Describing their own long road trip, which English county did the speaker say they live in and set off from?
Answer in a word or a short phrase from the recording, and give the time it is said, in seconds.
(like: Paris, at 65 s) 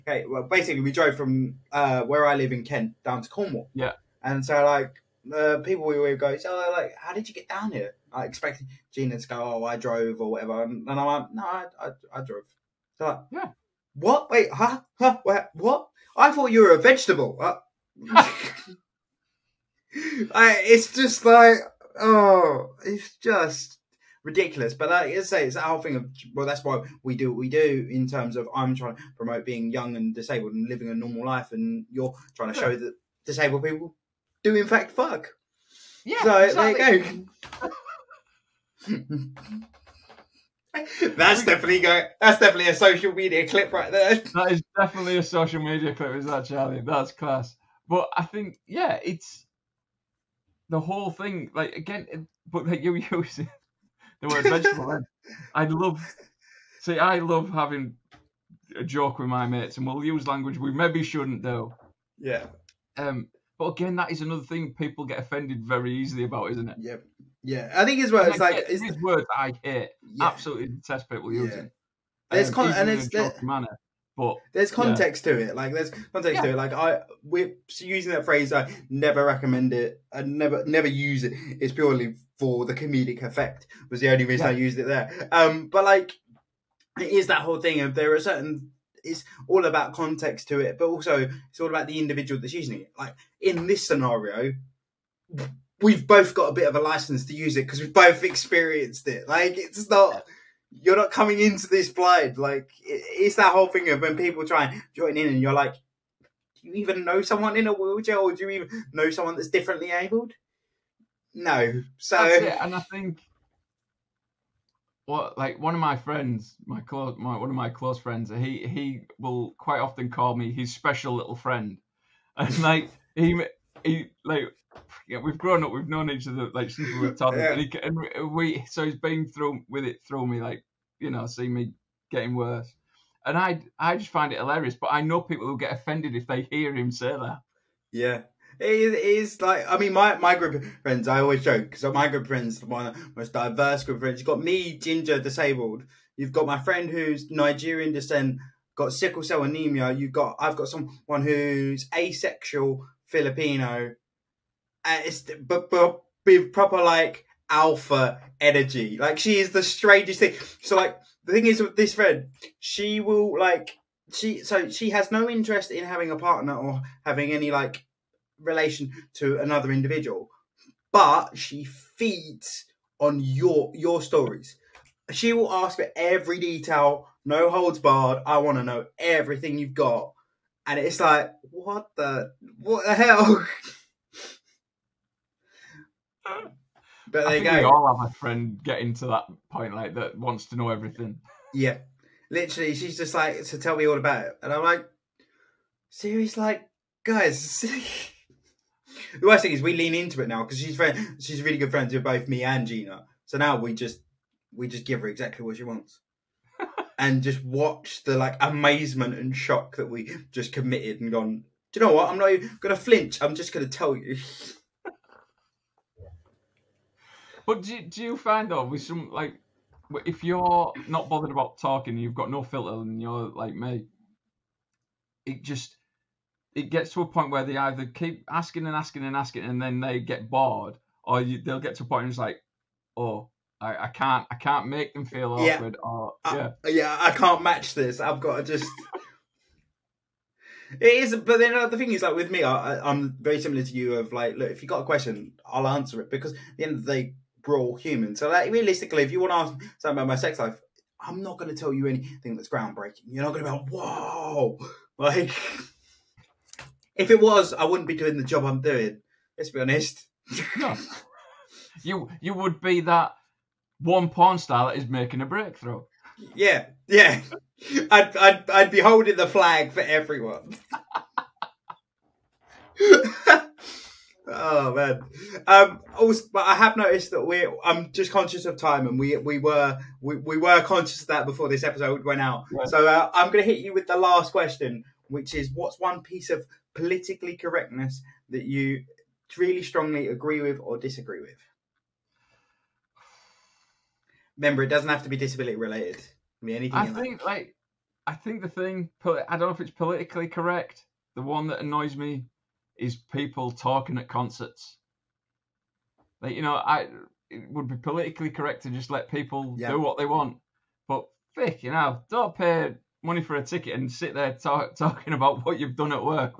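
Kent, at 2 s.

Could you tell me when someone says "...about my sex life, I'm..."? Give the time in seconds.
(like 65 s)
249 s.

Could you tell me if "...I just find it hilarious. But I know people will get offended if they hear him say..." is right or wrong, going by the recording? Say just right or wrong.
right.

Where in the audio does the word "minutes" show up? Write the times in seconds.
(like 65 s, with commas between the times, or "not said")
not said.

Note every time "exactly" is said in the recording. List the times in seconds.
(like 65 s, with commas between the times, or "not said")
36 s, 205 s.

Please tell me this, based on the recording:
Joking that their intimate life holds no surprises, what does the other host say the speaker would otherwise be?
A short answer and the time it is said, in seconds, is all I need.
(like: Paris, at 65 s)
porn star, at 264 s.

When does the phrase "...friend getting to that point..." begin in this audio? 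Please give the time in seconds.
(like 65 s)
188 s.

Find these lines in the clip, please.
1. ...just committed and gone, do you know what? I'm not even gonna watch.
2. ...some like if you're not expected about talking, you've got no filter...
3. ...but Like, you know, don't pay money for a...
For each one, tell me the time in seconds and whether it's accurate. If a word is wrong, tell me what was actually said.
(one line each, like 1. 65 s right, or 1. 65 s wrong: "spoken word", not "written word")
1. 210 s wrong: "flinch", not "watch"
2. 218 s wrong: "bothered", not "expected"
3. 310 s wrong: "Vic", not "Like".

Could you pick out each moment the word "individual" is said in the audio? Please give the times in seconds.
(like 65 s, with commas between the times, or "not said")
91 s, 169 s.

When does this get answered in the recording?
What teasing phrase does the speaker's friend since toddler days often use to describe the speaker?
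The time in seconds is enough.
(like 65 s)
120 s.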